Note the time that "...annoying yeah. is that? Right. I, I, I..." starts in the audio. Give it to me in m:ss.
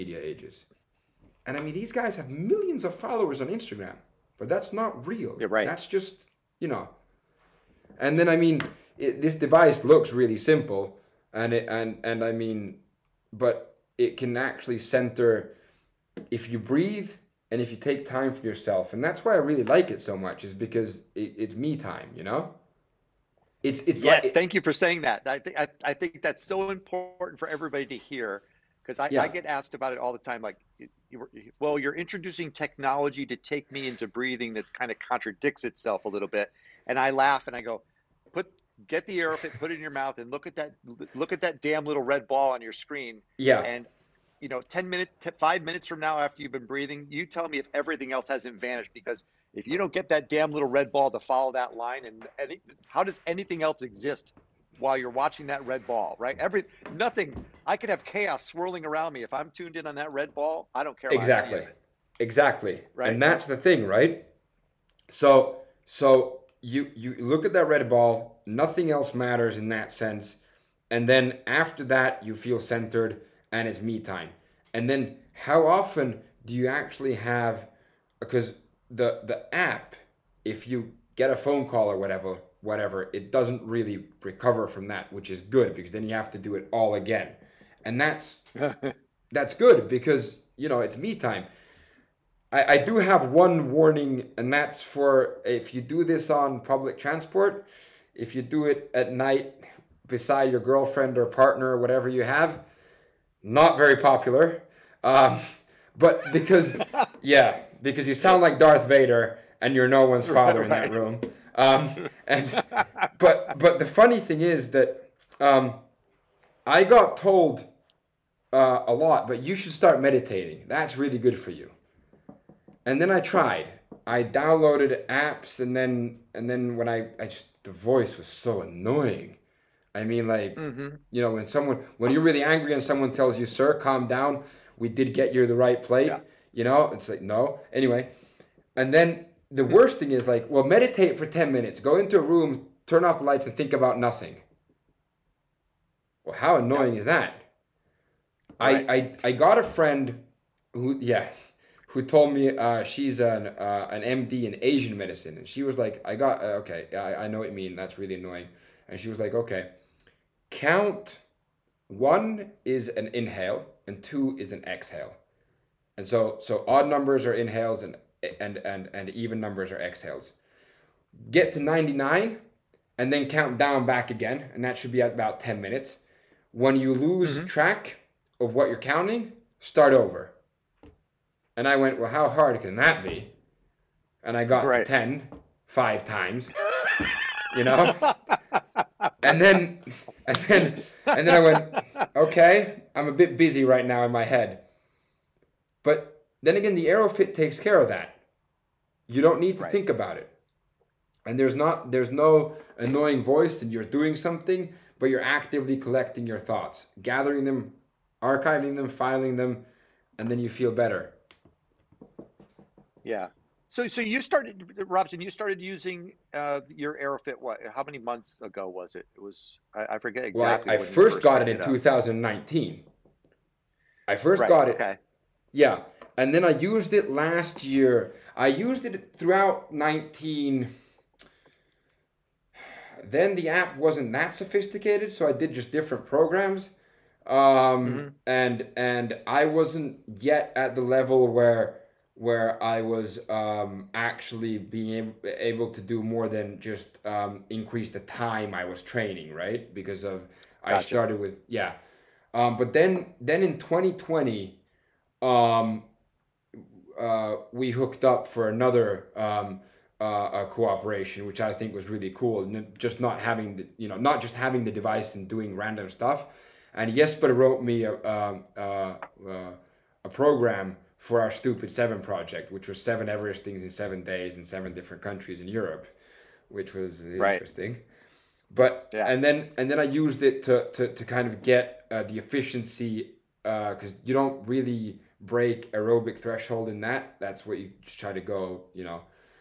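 2:26.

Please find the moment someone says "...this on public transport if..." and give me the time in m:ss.
1:36.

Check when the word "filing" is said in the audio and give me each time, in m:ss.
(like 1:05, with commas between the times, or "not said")
3:28.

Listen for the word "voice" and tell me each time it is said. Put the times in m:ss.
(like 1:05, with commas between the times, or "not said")
2:07, 3:23.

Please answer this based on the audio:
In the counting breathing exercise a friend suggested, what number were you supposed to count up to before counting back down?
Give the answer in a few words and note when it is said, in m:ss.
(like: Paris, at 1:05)
99, at 2:51.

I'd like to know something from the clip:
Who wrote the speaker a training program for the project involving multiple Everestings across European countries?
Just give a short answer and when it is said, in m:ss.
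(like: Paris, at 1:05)
Jesper, at 4:26.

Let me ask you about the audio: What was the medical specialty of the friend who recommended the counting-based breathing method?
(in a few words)
Asian medicine.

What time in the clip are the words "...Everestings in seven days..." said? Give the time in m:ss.
4:33.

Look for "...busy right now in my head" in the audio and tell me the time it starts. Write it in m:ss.
3:13.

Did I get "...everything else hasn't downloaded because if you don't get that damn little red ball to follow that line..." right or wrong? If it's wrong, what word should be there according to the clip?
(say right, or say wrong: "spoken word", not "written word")
wrong: "vanished", not "downloaded".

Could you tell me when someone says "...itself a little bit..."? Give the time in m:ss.
0:35.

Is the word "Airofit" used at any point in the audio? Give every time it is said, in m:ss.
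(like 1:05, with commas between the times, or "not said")
3:16, 3:37.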